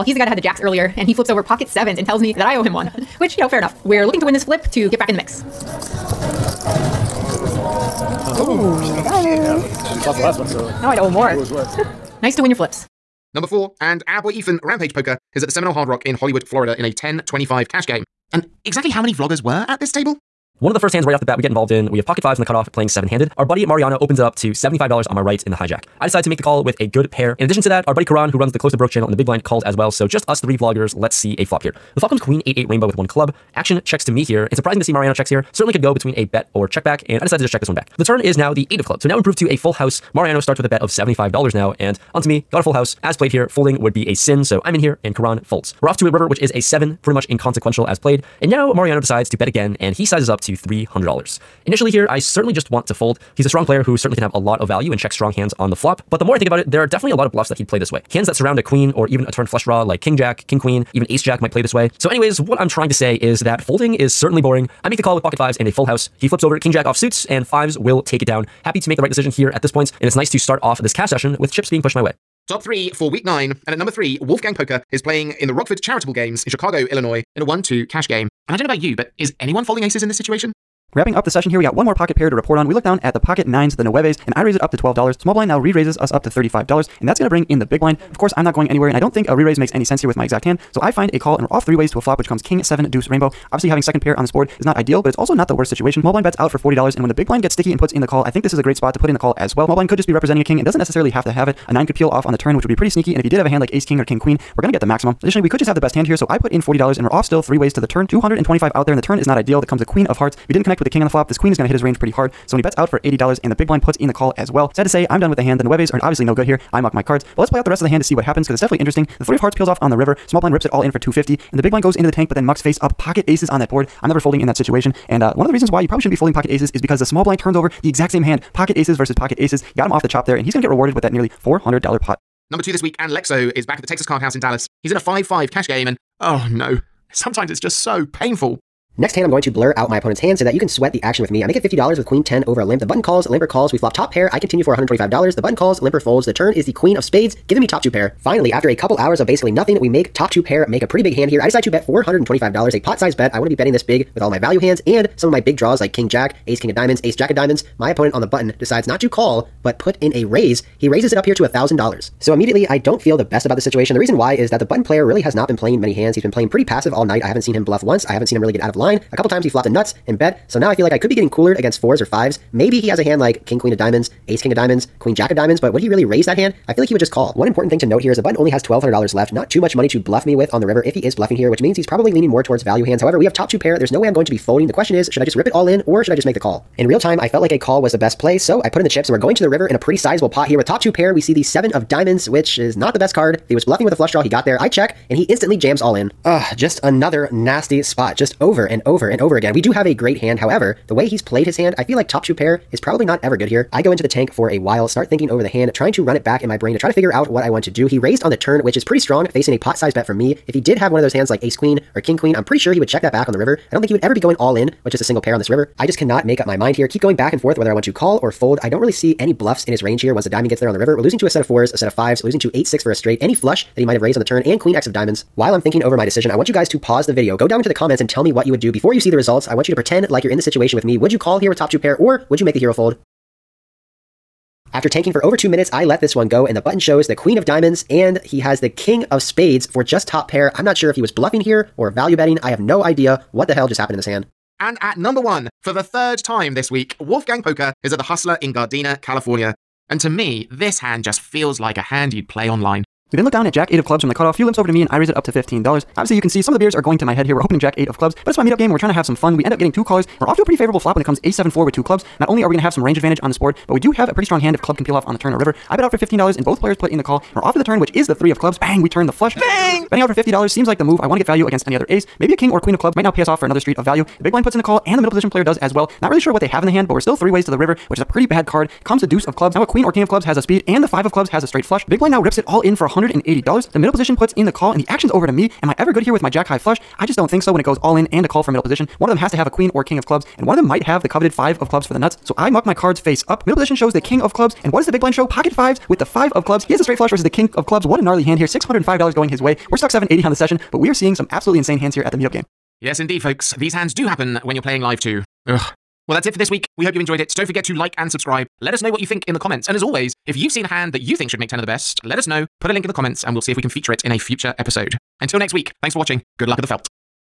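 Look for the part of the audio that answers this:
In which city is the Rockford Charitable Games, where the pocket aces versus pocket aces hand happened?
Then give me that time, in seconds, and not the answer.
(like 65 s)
76 s.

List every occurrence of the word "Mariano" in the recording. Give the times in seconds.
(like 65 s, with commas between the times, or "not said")
23 s, 34 s, 40 s, 48 s.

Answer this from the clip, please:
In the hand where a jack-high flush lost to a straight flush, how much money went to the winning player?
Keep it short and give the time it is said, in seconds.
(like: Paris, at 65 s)
$605, at 298 s.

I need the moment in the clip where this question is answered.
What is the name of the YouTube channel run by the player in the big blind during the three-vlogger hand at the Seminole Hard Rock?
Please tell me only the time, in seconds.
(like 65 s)
28 s.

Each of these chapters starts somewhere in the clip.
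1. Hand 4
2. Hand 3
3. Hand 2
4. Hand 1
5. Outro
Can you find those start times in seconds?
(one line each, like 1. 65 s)
1. 12 s
2. 72 s
3. 132 s
4. 244 s
5. 302 s.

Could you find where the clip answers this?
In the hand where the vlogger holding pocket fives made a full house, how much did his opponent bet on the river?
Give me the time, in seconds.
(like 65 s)
50 s.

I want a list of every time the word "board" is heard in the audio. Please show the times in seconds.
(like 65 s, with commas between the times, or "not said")
94 s, 123 s, 263 s.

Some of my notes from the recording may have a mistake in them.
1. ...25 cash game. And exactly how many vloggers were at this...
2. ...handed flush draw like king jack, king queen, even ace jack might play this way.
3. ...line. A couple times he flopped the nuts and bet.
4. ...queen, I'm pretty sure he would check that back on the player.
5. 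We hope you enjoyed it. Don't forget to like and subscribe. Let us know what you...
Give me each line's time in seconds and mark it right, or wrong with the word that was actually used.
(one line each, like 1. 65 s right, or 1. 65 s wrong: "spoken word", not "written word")
1. 17 s right
2. 59 s wrong: "turned", not "handed"
3. 168 s right
4. 212 s wrong: "river", not "player"
5. 306 s right.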